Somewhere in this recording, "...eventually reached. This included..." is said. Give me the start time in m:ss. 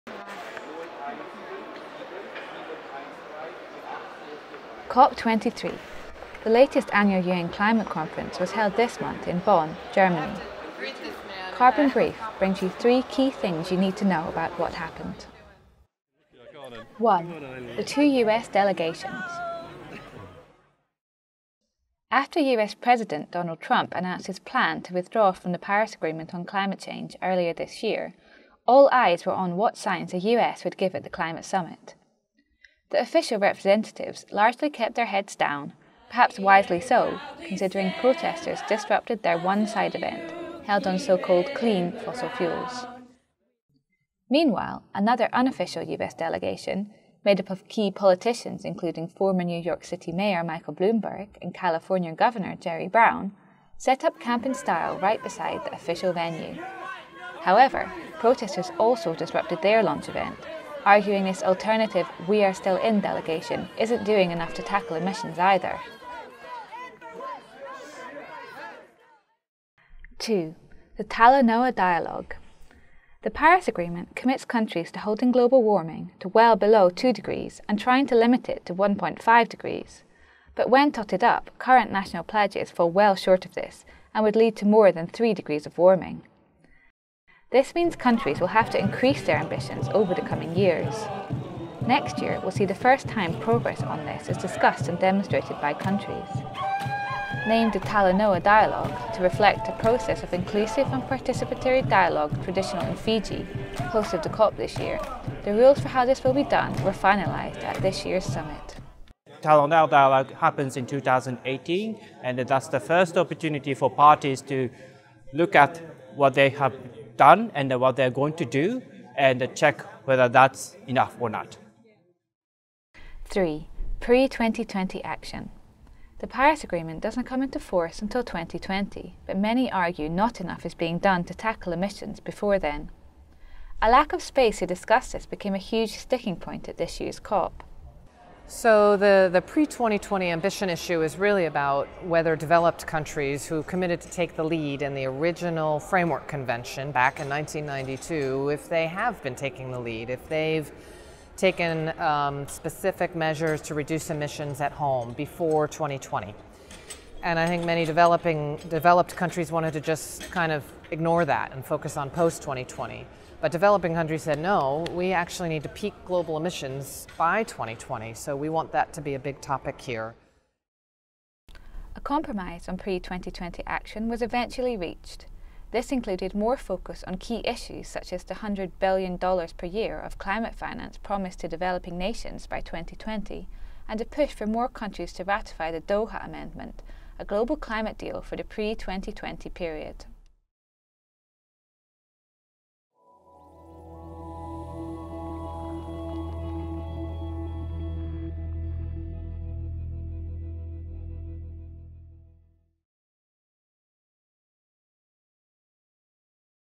2:54.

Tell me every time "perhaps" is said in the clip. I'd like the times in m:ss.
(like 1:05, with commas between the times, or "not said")
0:36.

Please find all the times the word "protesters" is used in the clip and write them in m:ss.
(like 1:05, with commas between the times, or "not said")
0:38, 0:58.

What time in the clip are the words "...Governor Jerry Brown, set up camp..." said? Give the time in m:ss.
0:52.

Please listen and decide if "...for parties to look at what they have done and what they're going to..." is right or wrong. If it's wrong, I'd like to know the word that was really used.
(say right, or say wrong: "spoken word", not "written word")
right.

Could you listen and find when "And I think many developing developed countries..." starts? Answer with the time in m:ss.
2:37.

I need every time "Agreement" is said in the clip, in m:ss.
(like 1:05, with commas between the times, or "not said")
0:25, 1:13, 2:06.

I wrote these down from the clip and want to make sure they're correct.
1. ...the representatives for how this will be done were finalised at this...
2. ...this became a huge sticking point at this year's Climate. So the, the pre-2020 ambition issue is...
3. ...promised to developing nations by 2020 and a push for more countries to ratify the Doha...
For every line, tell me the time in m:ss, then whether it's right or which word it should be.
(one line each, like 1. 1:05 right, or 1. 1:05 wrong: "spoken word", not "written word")
1. 1:45 wrong: "rules", not "representatives"
2. 2:15 wrong: "COP", not "Climate"
3. 3:00 right.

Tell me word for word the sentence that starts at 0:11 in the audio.
Carbon Brief brings you three key things you need to know about what happened.